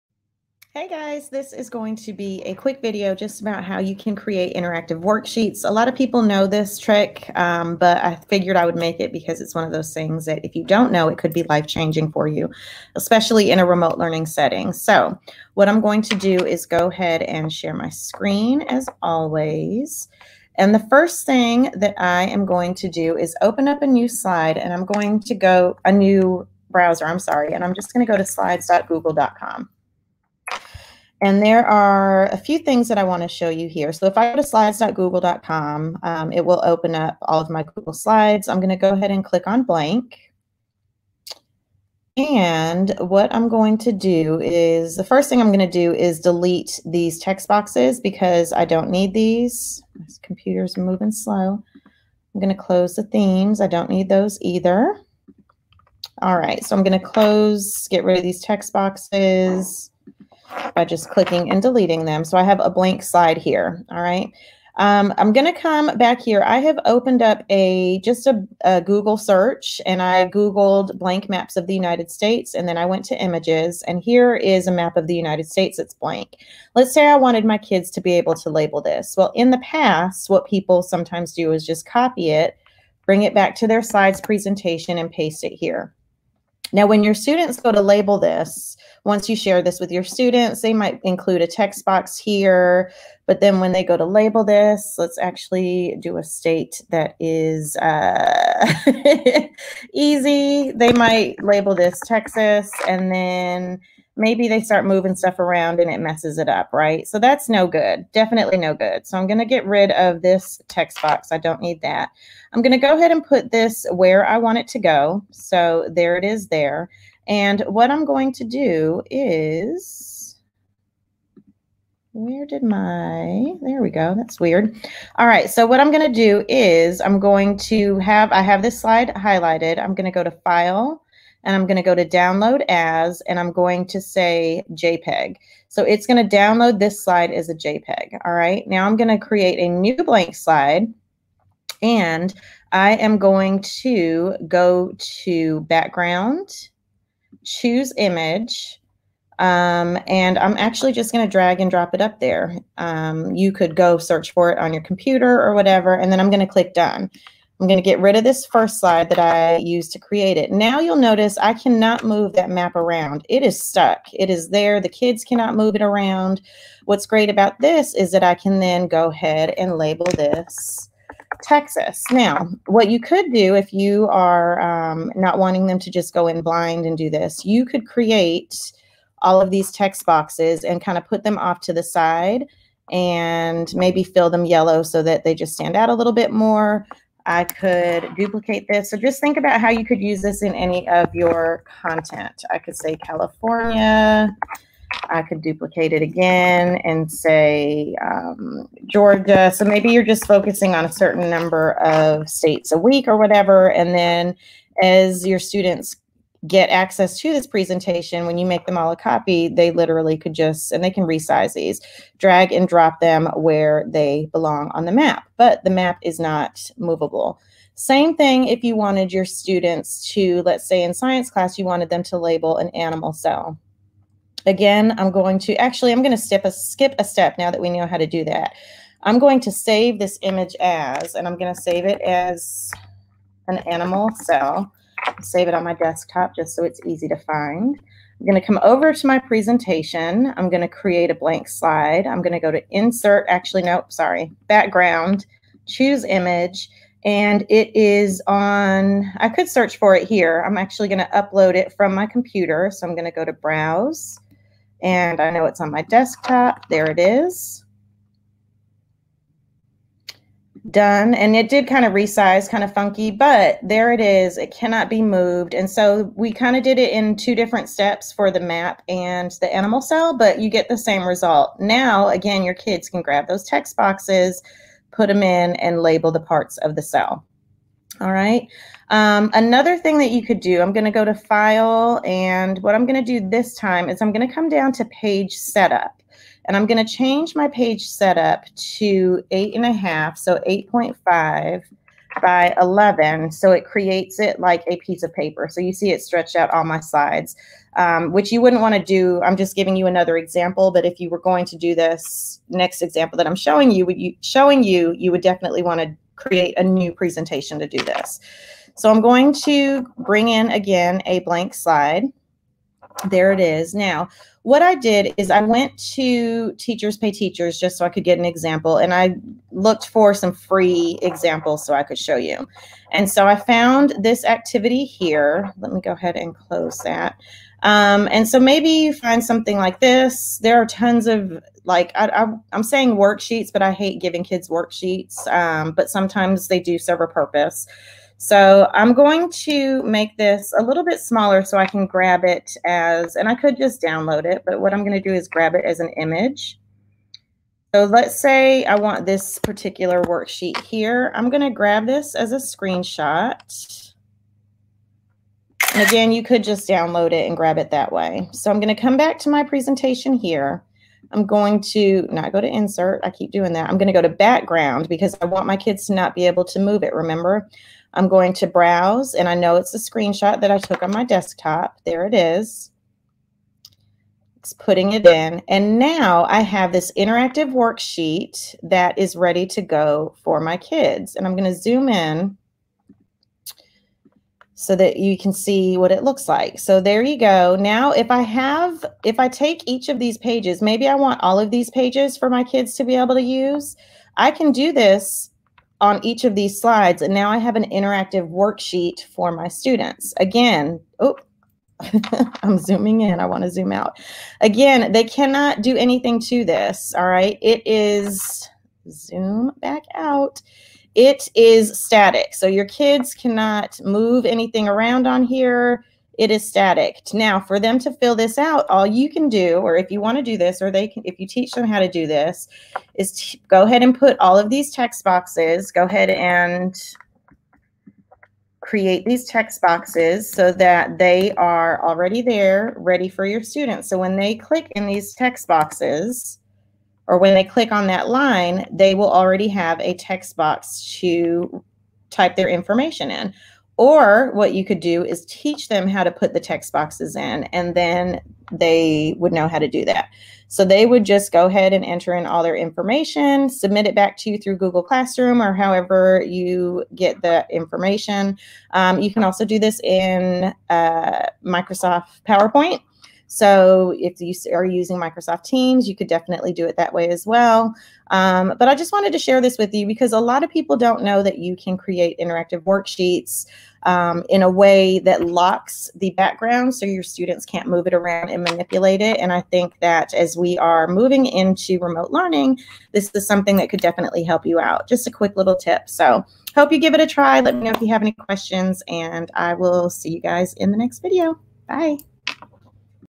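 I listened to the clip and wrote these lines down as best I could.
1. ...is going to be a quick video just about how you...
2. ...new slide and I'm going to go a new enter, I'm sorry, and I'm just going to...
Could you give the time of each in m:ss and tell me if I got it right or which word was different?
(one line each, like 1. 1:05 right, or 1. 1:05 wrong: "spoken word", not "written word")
1. 0:01 right
2. 0:23 wrong: "browser", not "enter".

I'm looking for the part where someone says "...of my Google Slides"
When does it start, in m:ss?
0:37.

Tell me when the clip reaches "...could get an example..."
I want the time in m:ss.
5:17.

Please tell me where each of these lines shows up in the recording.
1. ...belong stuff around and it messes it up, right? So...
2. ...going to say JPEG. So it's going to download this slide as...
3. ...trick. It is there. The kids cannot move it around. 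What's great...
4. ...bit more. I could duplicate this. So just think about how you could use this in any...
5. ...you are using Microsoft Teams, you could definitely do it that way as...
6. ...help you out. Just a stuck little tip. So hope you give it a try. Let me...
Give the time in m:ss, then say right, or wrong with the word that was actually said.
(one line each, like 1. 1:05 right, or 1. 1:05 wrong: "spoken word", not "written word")
1. 1:44 wrong: "moving", not "belong"
2. 2:13 right
3. 2:43 wrong: "stuck", not "trick"
4. 3:06 right
5. 7:44 right
6. 8:04 wrong: "quick", not "stuck".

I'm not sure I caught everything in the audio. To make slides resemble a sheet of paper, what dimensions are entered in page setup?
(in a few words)
8.5 by 11.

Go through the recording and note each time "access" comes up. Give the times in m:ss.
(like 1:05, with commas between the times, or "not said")
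3:26.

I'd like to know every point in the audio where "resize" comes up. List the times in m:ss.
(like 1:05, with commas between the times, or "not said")
3:31, 4:21.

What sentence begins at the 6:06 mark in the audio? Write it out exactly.
Remember, I'm going to browse, and I know it's a screenshot that I took on my desktop.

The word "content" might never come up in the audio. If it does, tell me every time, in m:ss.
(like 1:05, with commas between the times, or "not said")
3:11.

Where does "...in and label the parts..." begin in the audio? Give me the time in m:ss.
4:35.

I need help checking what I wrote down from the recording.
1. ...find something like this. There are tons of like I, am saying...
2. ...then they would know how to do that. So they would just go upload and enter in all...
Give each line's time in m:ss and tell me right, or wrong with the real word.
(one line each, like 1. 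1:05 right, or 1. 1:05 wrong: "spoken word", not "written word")
1. 5:28 right
2. 7:27 wrong: "ahead", not "upload".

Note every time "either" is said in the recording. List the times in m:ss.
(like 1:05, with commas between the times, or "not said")
0:54.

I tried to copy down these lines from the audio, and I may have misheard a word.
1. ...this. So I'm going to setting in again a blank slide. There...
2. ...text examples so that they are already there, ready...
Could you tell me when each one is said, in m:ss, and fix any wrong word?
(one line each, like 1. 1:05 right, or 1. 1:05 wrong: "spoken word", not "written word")
1. 5:07 wrong: "bring", not "setting"
2. 7:09 wrong: "boxes", not "examples".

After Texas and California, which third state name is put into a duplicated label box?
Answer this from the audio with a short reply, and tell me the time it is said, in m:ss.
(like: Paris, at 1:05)
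Georgia, at 3:18.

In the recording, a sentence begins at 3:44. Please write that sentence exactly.
Again, I'm going to, actually, I'm going to skip a, skip a step now that we know how to do that.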